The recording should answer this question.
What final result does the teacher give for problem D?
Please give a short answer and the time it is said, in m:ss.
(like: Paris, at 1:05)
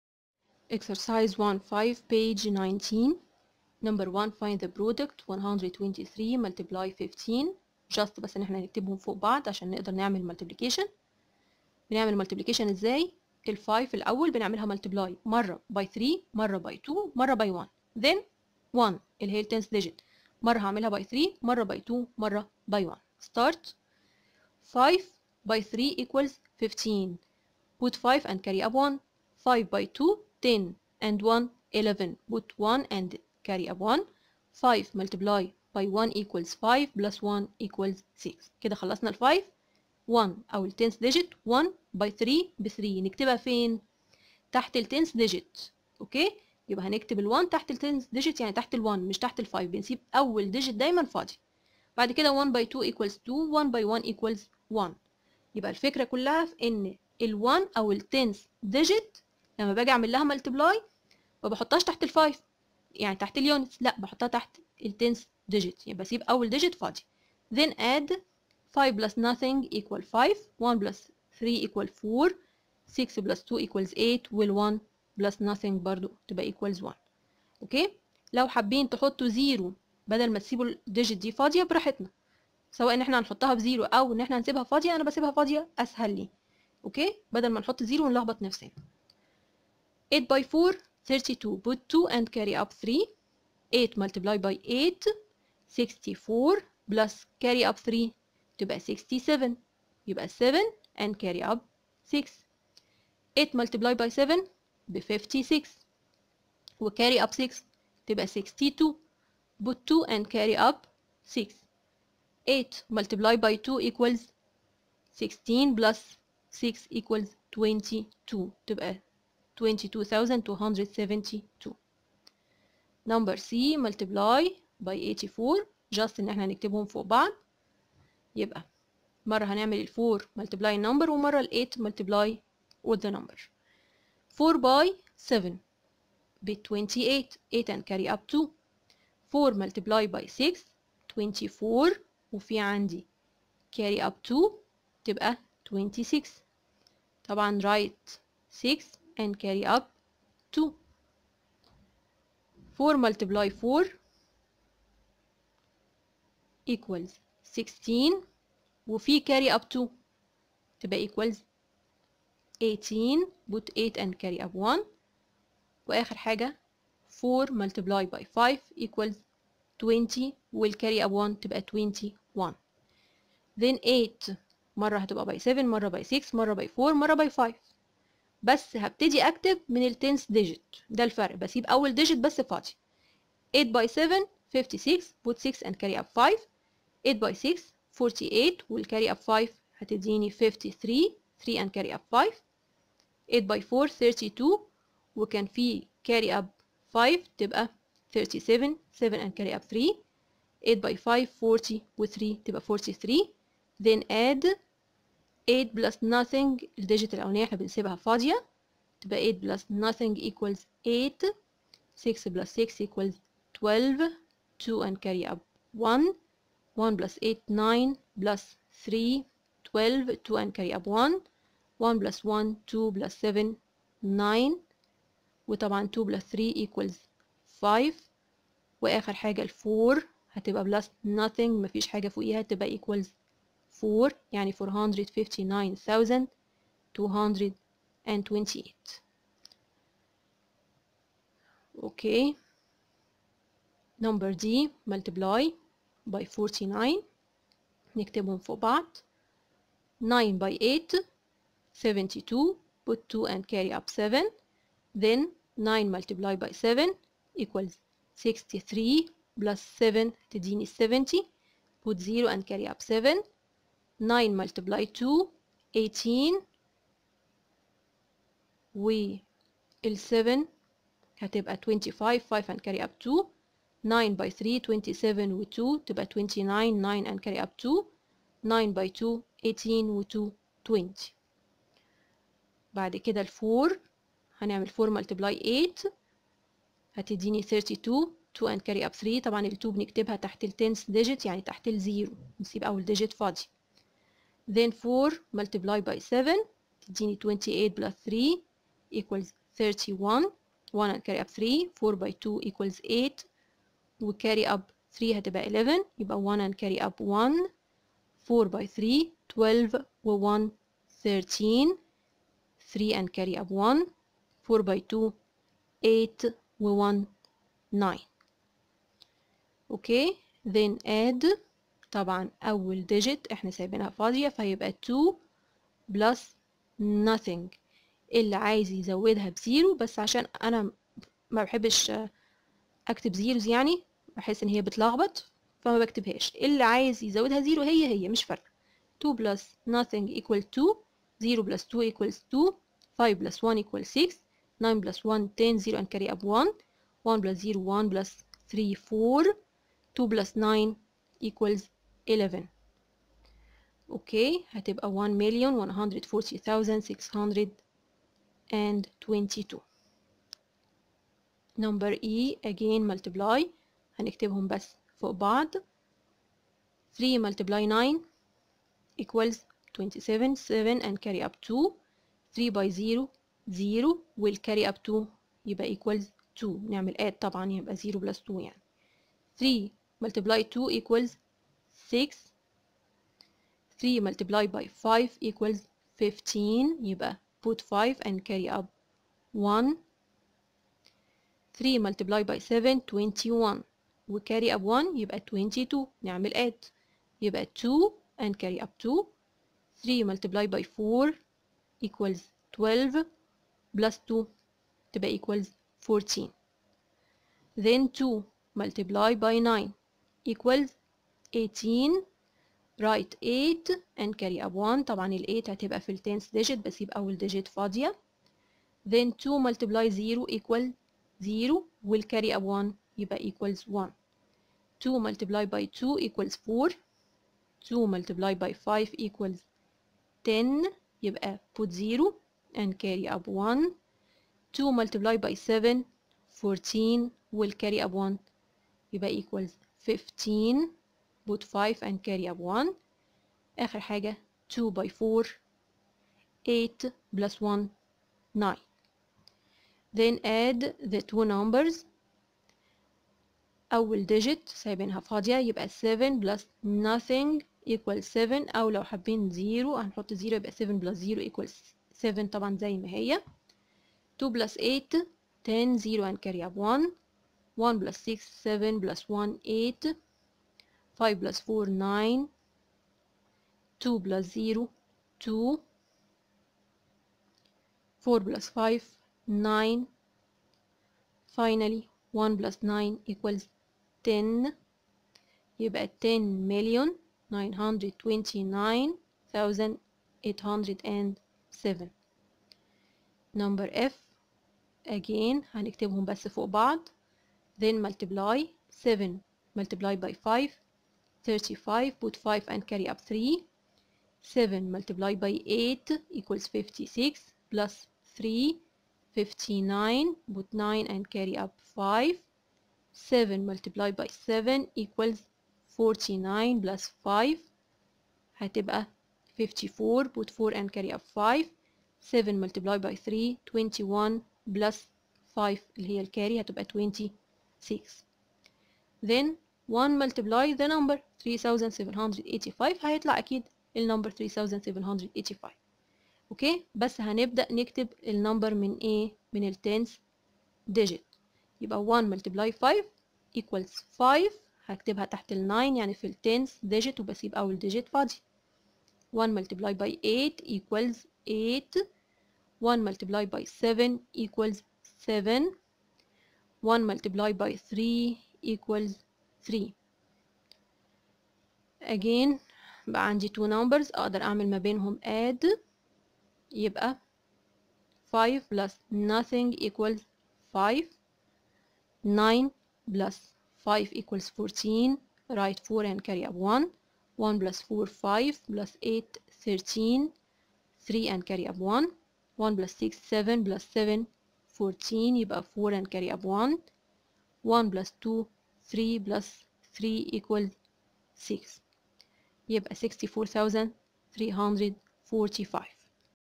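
1,140,622, at 5:54.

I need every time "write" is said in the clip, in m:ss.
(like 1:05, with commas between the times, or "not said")
2:27, 6:52, 9:35.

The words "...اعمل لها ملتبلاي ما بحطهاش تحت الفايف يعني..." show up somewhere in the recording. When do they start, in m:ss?
0:59.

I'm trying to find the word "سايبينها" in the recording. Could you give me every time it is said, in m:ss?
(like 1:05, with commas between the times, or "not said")
5:23, 7:34.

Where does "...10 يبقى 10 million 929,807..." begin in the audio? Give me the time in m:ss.
8:04.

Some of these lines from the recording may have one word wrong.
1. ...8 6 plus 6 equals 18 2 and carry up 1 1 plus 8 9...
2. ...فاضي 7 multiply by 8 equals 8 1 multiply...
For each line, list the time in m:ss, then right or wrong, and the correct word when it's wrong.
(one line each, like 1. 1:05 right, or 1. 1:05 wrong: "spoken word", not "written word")
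1. 3:30 wrong: "12", not "18"
2. 9:07 wrong: "1", not "7".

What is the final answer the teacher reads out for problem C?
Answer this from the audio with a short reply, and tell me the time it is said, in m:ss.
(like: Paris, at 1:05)
459228, at 3:54.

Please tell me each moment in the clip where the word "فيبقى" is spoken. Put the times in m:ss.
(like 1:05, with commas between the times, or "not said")
5:24.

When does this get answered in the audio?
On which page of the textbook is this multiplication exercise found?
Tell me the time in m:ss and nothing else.
0:02.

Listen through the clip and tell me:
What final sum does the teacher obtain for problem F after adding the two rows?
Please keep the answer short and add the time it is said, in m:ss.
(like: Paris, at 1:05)
64345, at 9:52.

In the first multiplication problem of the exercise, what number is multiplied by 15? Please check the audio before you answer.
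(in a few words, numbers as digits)
123.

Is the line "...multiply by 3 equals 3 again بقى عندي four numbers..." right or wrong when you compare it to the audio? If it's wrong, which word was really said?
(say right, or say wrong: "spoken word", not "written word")
wrong: "two", not "four".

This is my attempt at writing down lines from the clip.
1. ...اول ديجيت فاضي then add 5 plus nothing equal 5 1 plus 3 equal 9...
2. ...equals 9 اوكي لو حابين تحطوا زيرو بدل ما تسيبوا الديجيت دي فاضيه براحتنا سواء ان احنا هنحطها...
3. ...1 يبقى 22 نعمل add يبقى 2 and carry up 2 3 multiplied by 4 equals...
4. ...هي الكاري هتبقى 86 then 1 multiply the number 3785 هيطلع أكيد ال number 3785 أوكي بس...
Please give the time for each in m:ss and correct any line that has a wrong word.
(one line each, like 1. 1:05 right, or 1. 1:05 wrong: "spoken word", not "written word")
1. 1:06 wrong: "4", not "9"
2. 1:16 wrong: "1", not "9"
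3. 6:34 right
4. 8:45 wrong: "26", not "86".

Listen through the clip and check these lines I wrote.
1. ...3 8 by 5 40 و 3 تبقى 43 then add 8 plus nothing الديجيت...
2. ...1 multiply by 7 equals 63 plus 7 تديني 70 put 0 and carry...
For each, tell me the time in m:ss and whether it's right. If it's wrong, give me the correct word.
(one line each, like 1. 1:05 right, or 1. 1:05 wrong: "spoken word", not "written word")
1. 3:19 right
2. 4:15 wrong: "9", not "1".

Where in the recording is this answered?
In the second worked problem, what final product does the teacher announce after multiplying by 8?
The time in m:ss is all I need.
1:59.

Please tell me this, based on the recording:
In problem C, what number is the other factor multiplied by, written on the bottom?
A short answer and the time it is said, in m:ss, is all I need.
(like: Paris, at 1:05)
84, at 2:04.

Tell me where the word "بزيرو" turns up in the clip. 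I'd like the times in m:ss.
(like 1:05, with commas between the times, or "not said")
1:23, 5:29.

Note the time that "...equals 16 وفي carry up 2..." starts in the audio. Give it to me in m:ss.
2:36.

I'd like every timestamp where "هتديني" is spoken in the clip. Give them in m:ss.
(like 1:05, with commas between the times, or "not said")
3:09, 4:46.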